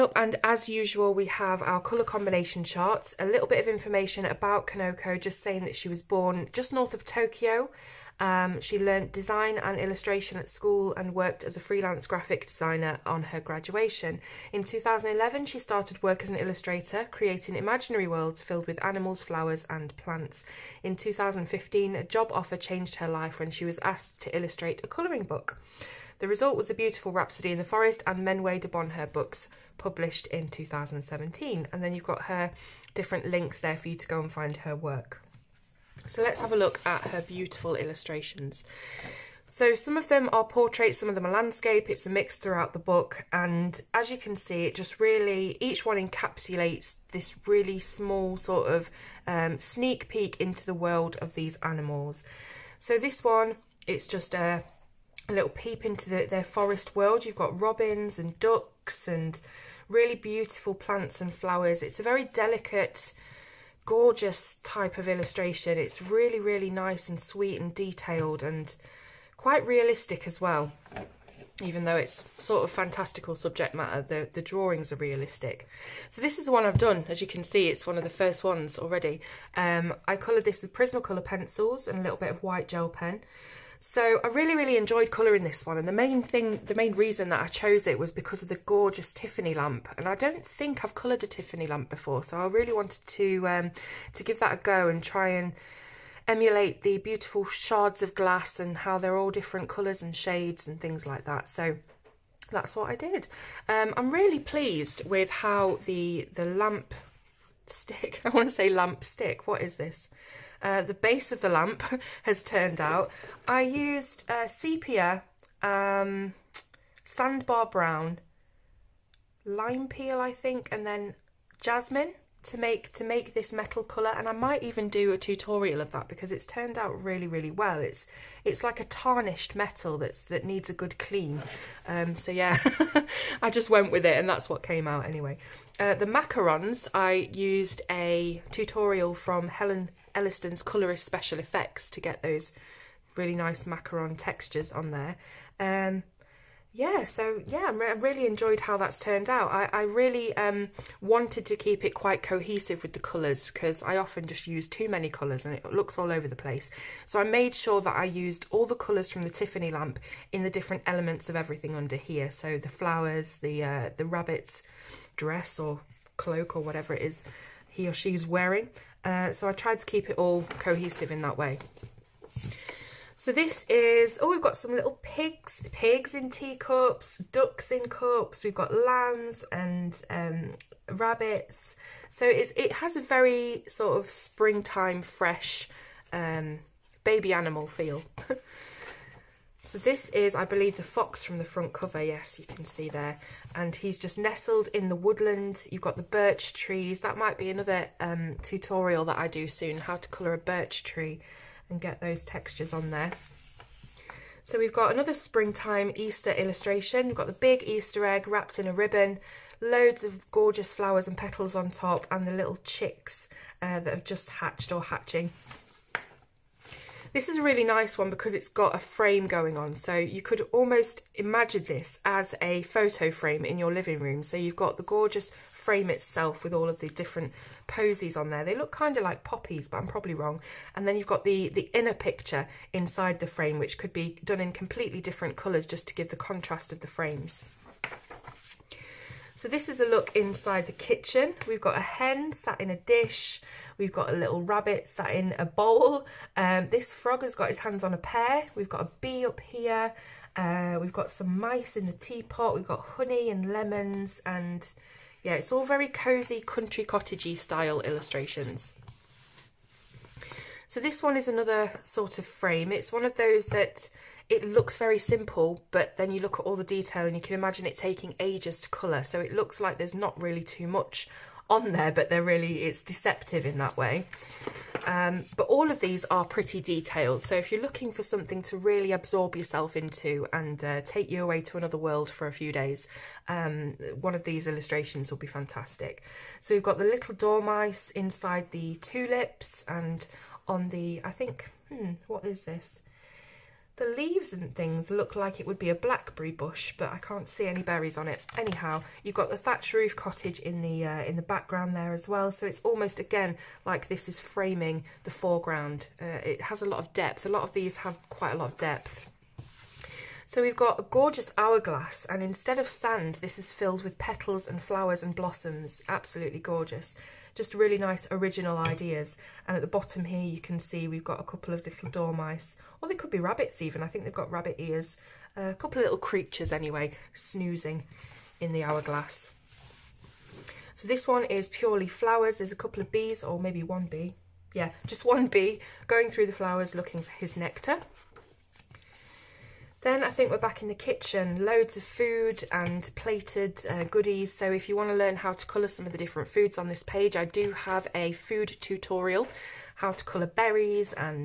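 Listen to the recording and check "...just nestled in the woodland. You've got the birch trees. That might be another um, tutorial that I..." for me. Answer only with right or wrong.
right.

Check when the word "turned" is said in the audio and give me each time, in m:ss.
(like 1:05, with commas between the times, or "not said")
1:52, 2:06, 2:28.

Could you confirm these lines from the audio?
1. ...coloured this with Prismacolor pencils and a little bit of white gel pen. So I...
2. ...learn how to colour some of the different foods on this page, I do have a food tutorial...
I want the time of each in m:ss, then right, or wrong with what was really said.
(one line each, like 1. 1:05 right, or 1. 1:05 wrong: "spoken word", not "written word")
1. 1:20 right
2. 5:44 right.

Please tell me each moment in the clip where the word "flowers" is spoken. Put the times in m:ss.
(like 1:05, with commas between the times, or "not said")
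0:19, 1:01, 2:42, 3:30, 5:14, 5:31, 5:36.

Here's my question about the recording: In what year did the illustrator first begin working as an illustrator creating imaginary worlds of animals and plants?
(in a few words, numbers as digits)
2011.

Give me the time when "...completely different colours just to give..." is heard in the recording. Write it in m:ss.
3:54.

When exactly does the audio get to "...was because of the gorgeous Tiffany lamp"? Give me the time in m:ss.
1:27.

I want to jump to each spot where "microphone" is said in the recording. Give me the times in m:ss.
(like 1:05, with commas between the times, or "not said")
not said.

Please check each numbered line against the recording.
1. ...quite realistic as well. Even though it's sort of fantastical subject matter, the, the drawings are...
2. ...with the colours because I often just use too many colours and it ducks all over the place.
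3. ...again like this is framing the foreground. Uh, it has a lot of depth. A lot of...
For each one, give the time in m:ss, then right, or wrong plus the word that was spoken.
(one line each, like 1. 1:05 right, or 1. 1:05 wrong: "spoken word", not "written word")
1. 1:09 right
2. 2:32 wrong: "looks", not "ducks"
3. 5:02 right.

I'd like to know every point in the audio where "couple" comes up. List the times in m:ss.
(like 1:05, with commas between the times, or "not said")
5:21, 5:25, 5:32.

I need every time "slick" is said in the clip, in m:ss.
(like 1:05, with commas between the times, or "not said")
not said.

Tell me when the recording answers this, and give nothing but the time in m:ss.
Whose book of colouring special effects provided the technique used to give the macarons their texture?
2:19.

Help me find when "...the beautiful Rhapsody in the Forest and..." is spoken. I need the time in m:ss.
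0:26.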